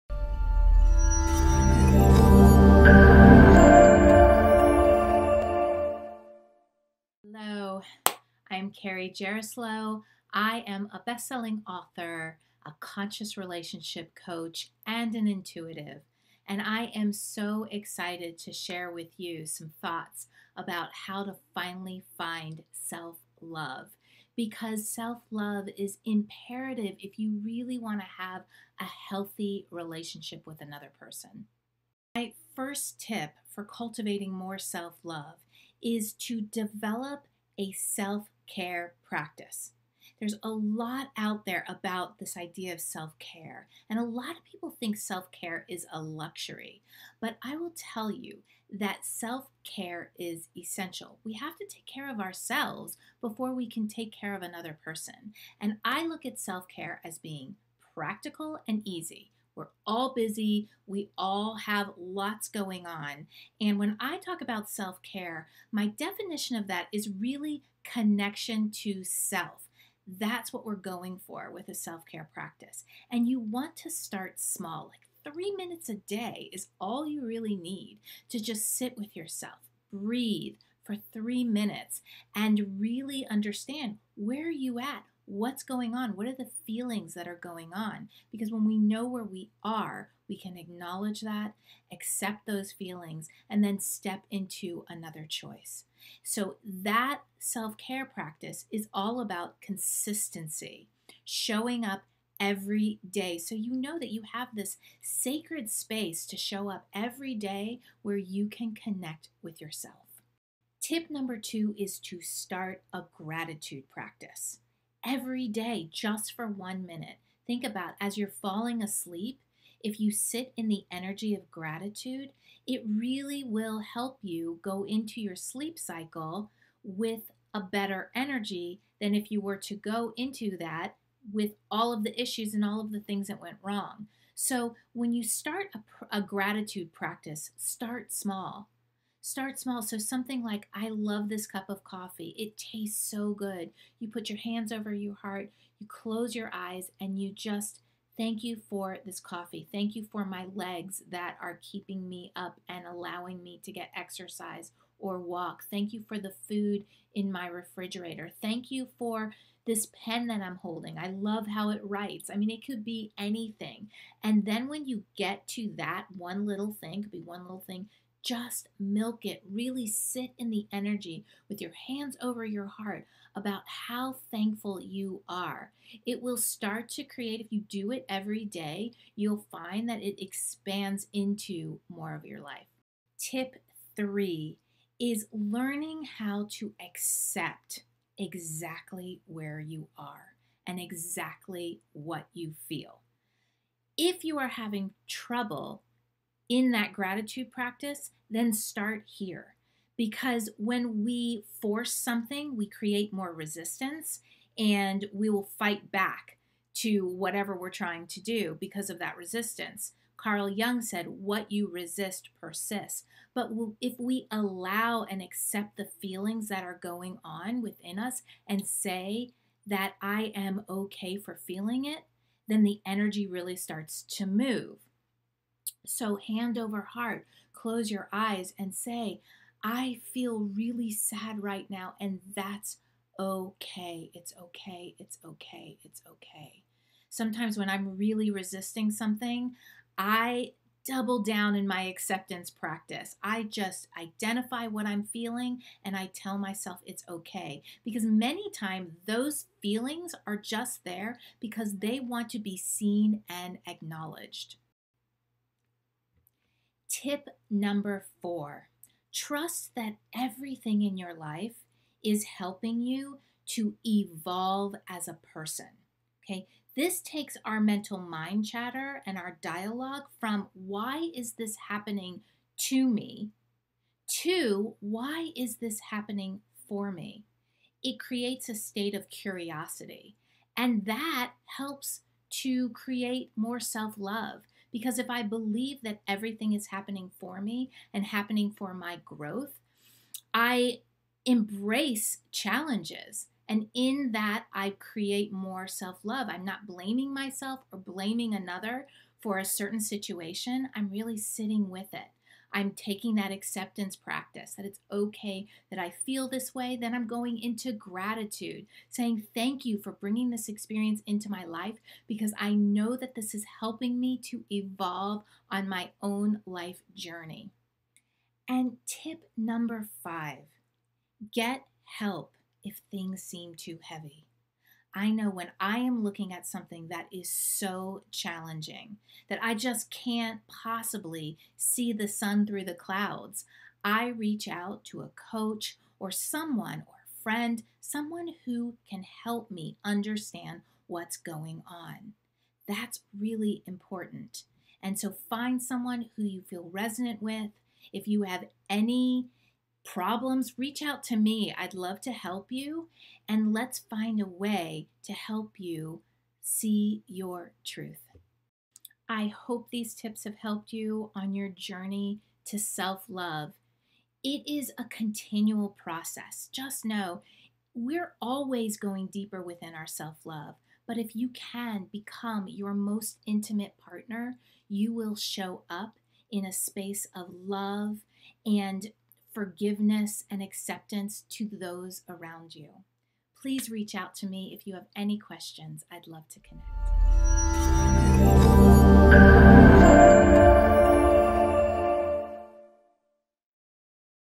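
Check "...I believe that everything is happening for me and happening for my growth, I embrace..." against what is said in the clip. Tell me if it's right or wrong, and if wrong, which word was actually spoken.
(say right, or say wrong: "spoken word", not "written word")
right.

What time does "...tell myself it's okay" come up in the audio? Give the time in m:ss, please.
4:06.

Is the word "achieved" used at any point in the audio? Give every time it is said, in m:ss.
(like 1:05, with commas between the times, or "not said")
not said.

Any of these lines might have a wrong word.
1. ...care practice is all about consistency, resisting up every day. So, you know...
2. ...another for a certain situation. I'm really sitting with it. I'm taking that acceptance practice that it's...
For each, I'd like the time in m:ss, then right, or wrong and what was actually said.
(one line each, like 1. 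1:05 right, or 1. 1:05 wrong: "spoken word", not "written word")
1. 1:37 wrong: "showing", not "resisting"
2. 4:58 right.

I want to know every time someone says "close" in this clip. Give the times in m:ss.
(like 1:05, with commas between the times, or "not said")
2:25, 3:47.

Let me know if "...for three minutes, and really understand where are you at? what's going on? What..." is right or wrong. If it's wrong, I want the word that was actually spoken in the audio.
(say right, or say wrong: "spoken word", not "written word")
right.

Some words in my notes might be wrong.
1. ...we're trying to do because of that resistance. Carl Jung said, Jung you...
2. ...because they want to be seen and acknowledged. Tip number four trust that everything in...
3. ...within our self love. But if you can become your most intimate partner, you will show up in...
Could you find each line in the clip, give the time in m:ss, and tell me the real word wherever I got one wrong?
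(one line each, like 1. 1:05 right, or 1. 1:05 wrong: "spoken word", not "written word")
1. 3:27 wrong: "What", not "Jung"
2. 4:11 right
3. 6:09 right.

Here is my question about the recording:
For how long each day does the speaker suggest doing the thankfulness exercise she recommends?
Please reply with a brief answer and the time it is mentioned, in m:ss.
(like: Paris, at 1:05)
1 minute, at 1:56.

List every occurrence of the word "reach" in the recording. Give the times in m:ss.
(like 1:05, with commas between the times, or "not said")
5:34, 5:50, 6:23.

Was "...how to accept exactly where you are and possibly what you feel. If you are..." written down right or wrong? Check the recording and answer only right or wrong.
wrong.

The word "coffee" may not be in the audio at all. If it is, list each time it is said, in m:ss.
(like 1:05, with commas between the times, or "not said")
2:21, 2:29.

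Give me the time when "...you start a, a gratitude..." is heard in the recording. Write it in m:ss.
2:15.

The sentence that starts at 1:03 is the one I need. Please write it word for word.
And when I talk about self care, my definition of that is really connection to self.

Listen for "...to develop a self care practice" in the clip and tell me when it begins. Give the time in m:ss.
0:36.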